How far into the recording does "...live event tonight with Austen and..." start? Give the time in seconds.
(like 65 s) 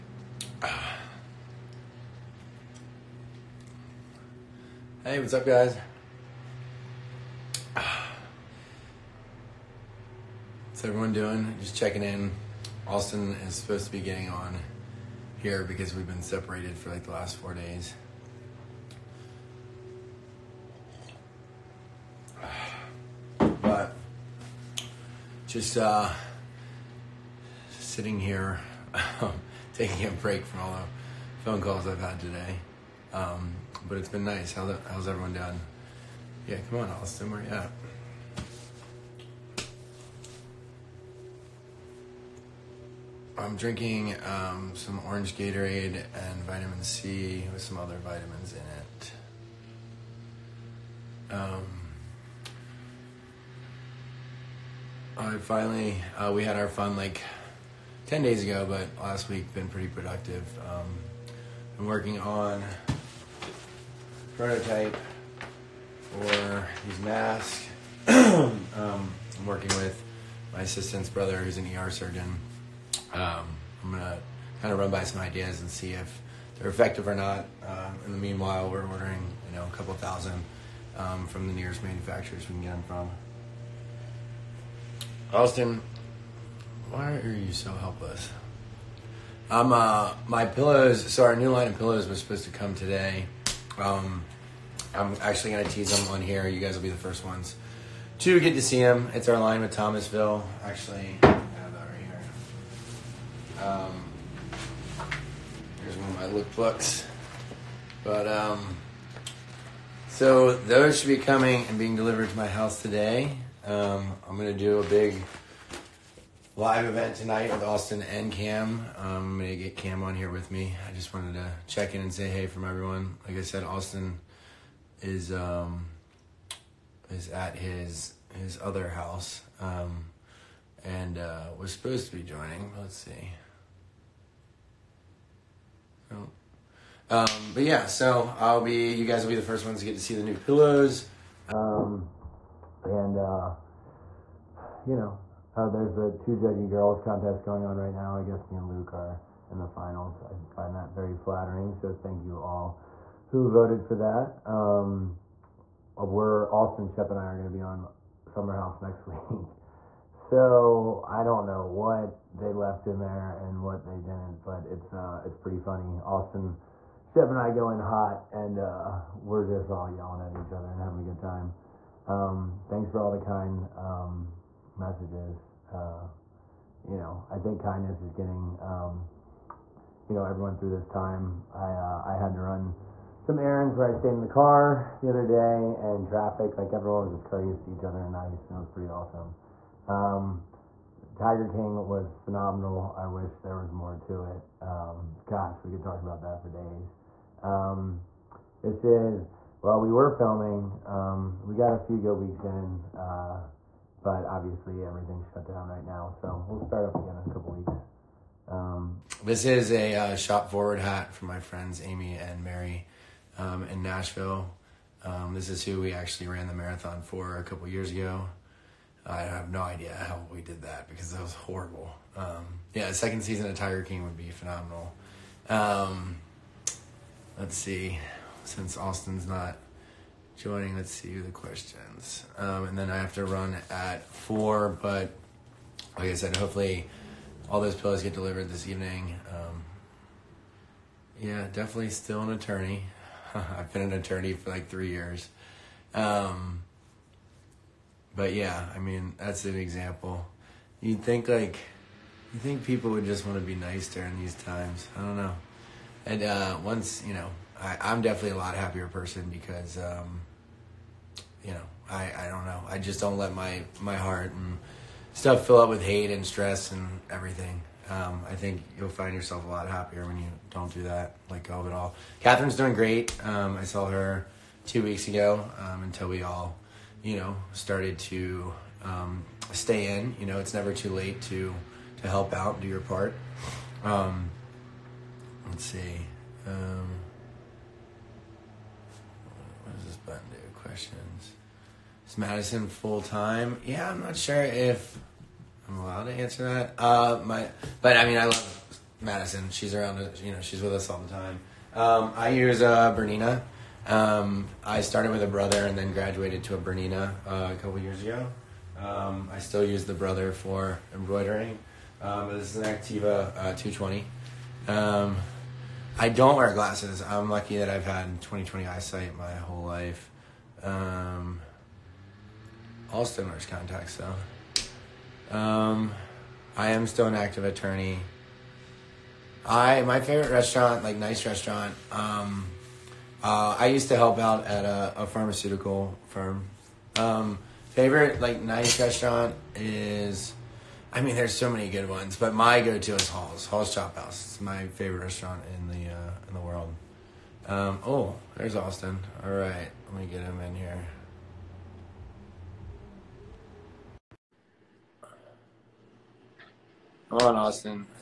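116 s.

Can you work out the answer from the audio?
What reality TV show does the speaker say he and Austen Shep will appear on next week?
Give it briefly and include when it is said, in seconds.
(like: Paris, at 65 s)
Summer House, at 158 s.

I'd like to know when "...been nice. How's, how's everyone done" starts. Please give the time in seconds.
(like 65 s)
34 s.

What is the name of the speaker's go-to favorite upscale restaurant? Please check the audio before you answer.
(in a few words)
Hall's Chop House.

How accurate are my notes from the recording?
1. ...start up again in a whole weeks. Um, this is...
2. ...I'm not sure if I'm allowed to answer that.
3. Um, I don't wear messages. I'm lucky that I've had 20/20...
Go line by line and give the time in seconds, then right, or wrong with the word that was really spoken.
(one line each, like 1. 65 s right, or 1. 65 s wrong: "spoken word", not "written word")
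1. 206 s wrong: "couple", not "whole"
2. 293 s right
3. 314 s wrong: "glasses", not "messages".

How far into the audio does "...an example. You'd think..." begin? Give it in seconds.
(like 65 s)
249 s.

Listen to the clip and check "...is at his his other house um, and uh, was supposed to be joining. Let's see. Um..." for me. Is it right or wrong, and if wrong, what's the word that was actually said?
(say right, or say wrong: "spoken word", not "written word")
right.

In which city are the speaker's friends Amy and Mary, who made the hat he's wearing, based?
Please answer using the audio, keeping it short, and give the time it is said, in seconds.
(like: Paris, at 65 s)
Nashville, at 213 s.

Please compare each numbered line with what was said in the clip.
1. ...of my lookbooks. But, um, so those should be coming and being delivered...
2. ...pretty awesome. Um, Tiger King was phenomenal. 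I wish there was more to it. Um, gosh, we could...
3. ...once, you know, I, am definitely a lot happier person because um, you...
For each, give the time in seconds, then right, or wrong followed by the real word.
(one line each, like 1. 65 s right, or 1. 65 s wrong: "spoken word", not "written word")
1. 106 s right
2. 188 s right
3. 256 s right.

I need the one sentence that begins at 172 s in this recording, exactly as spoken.
Um, thanks for all the kind.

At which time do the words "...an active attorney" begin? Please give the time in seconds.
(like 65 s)
327 s.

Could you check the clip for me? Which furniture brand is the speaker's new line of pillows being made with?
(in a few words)
Thomasville.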